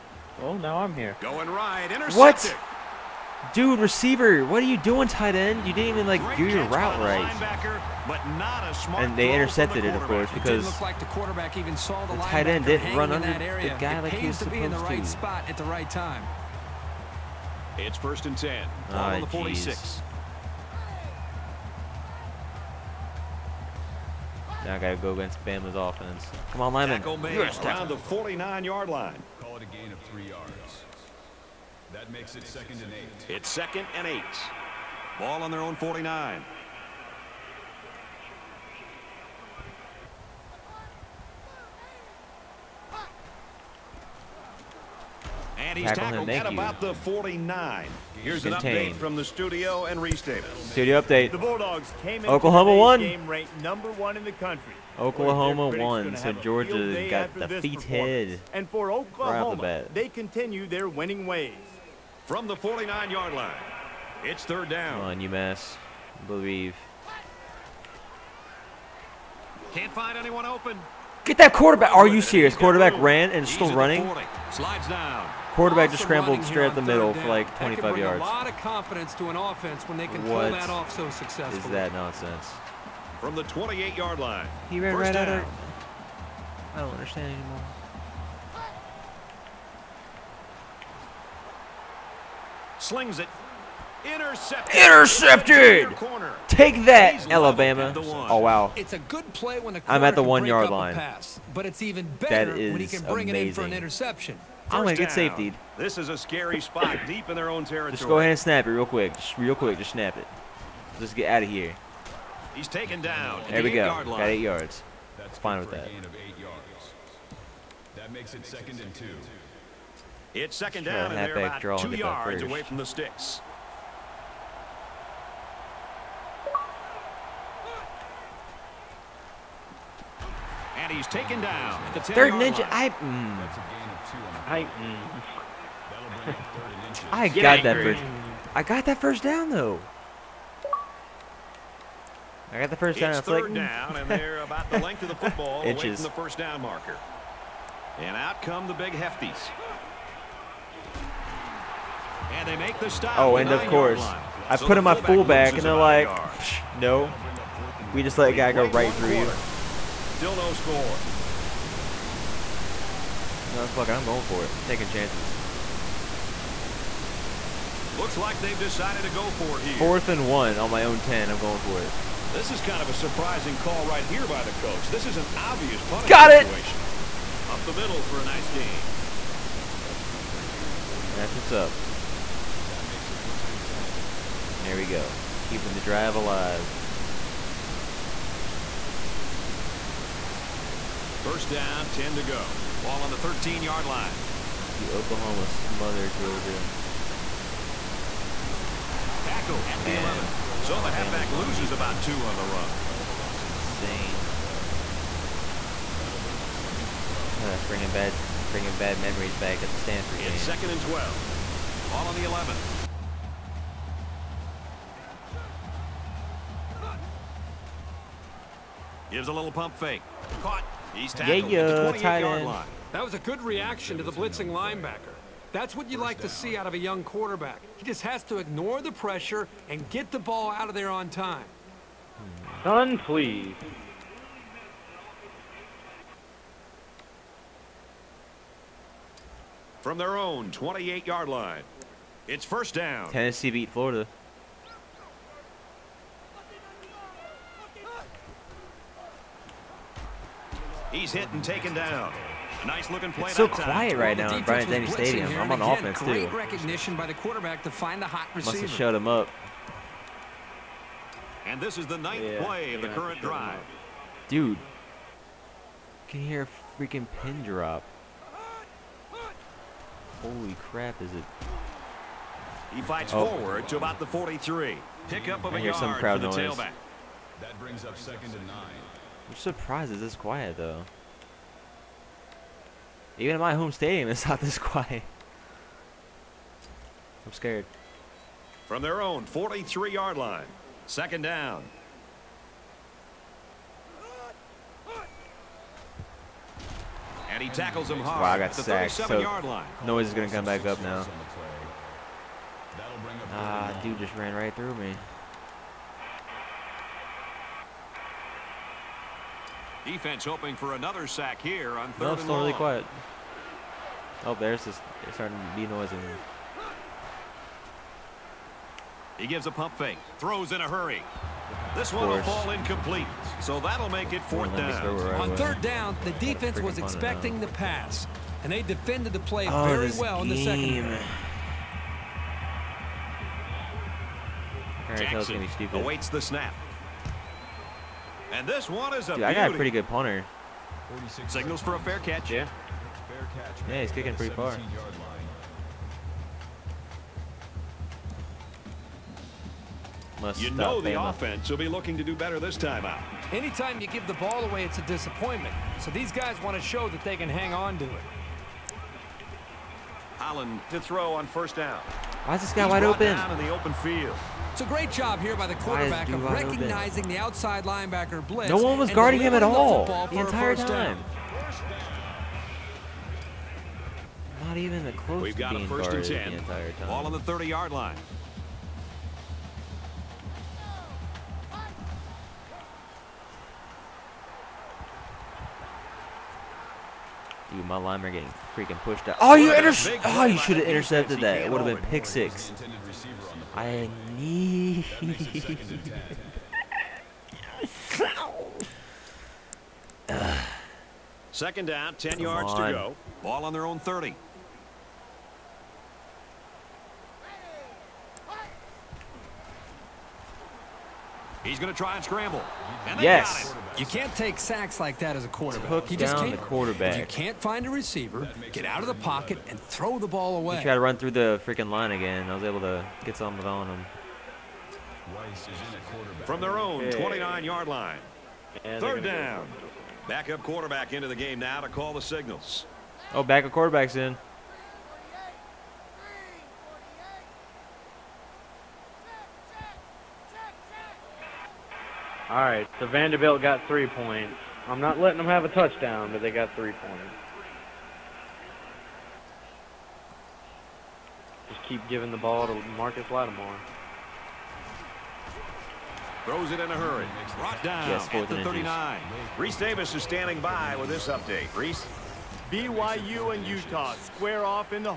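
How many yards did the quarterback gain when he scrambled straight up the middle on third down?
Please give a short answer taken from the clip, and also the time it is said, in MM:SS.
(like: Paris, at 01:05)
25, at 01:17.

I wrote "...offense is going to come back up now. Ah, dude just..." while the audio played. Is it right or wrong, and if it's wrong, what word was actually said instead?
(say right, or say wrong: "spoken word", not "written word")
wrong: "noise", not "offense".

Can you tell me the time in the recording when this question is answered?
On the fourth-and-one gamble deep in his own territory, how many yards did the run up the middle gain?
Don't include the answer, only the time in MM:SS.
03:00.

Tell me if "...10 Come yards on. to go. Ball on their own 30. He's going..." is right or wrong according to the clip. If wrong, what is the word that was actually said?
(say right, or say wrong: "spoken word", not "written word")
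right.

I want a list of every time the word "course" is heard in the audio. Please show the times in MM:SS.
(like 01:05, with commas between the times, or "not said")
00:10, 02:33.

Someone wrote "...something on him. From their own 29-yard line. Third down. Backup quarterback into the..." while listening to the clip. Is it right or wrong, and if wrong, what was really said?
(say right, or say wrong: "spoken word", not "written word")
right.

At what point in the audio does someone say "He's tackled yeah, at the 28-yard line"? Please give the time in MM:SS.
03:40.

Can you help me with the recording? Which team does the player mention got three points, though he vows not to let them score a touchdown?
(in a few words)
Vanderbilt.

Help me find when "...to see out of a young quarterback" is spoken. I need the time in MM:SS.
03:46.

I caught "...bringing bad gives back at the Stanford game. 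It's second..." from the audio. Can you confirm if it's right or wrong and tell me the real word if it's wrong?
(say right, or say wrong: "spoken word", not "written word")
wrong: "memories", not "gives".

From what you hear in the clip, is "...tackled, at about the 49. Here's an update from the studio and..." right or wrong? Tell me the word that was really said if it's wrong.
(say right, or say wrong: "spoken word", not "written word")
right.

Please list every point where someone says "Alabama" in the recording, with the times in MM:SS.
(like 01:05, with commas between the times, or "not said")
01:37.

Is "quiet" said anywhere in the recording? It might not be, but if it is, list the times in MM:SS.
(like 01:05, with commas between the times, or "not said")
04:13, 04:40, 04:44, 05:12.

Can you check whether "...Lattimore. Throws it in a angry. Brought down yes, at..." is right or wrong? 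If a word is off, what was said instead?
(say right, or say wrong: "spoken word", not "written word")
wrong: "hurry", not "angry".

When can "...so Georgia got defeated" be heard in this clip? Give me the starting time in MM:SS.
00:56.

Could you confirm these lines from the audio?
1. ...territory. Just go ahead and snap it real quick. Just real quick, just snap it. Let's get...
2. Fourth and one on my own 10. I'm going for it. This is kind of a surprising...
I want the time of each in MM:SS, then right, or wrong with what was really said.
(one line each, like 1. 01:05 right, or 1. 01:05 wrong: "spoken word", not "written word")
1. 01:47 right
2. 02:49 right.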